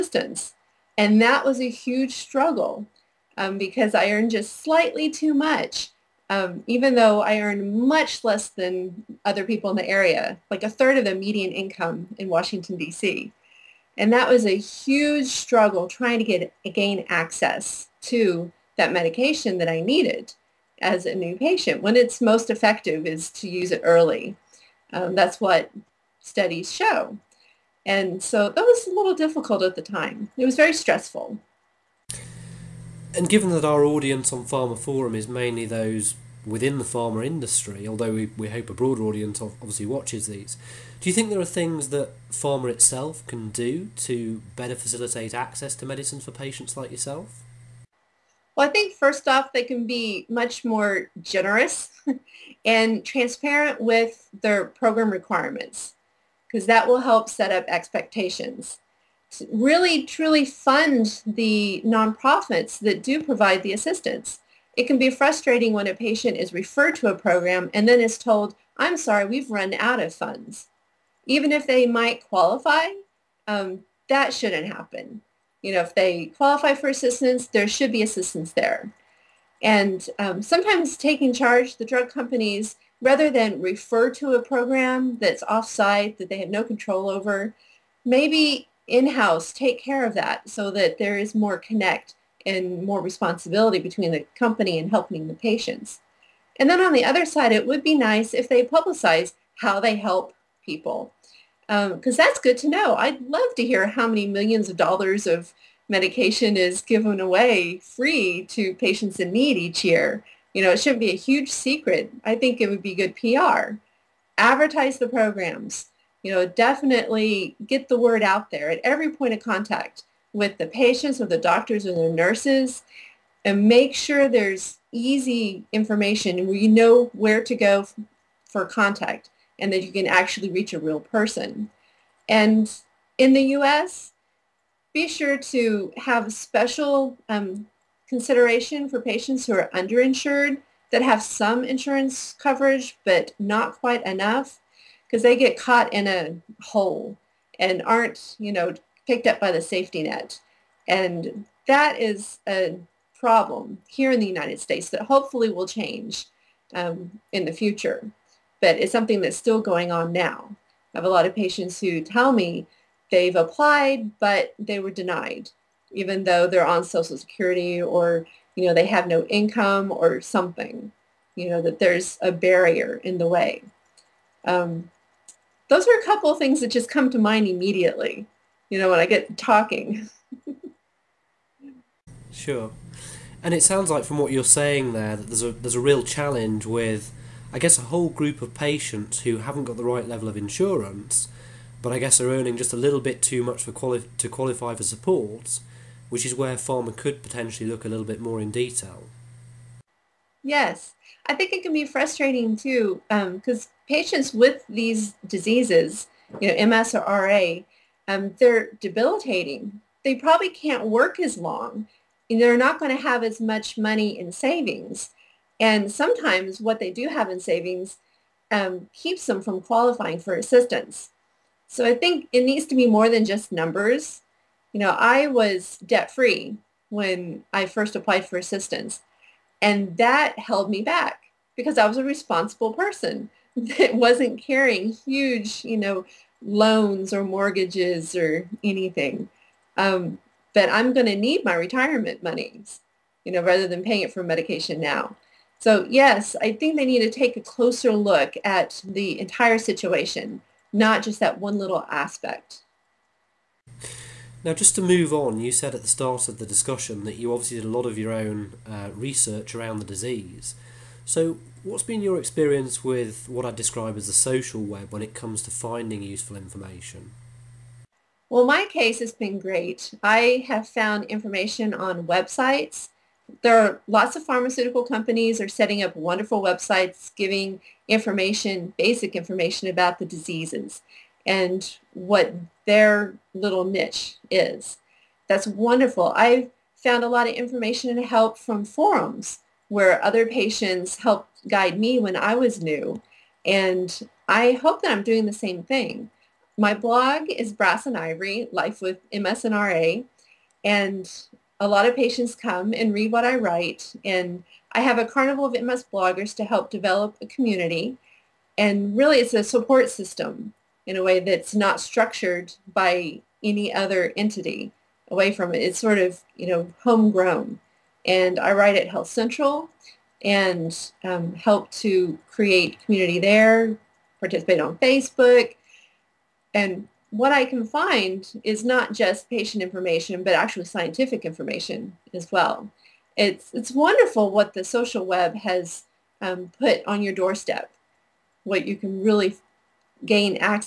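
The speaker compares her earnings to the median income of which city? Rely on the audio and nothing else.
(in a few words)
Washington, D.C.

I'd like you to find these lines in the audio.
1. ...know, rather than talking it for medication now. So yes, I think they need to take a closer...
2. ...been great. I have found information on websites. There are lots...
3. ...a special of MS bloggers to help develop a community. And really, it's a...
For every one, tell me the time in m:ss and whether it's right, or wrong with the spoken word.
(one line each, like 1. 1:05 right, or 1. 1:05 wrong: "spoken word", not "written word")
1. 4:03 wrong: "paying", not "talking"
2. 4:29 right
3. 5:04 wrong: "carnival", not "special".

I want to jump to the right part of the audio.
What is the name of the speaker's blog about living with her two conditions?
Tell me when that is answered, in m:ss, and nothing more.
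4:57.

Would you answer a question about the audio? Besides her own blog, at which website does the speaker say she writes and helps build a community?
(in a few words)
Health Central.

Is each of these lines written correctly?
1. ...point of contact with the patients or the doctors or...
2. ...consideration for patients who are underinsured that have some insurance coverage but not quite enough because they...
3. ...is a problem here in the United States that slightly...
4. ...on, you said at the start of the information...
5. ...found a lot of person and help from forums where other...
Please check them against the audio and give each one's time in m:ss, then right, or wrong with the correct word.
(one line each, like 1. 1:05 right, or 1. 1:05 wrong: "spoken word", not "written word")
1. 1:59 right
2. 2:18 right
3. 2:31 wrong: "hopefully", not "slightly"
4. 4:15 wrong: "discussion", not "information"
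5. 4:46 wrong: "information", not "person".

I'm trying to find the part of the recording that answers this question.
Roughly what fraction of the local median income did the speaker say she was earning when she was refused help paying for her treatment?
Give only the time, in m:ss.
0:10.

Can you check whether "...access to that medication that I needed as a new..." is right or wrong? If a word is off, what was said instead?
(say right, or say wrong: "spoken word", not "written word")
right.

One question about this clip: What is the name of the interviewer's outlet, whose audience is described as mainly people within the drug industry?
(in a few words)
pharmaphorum.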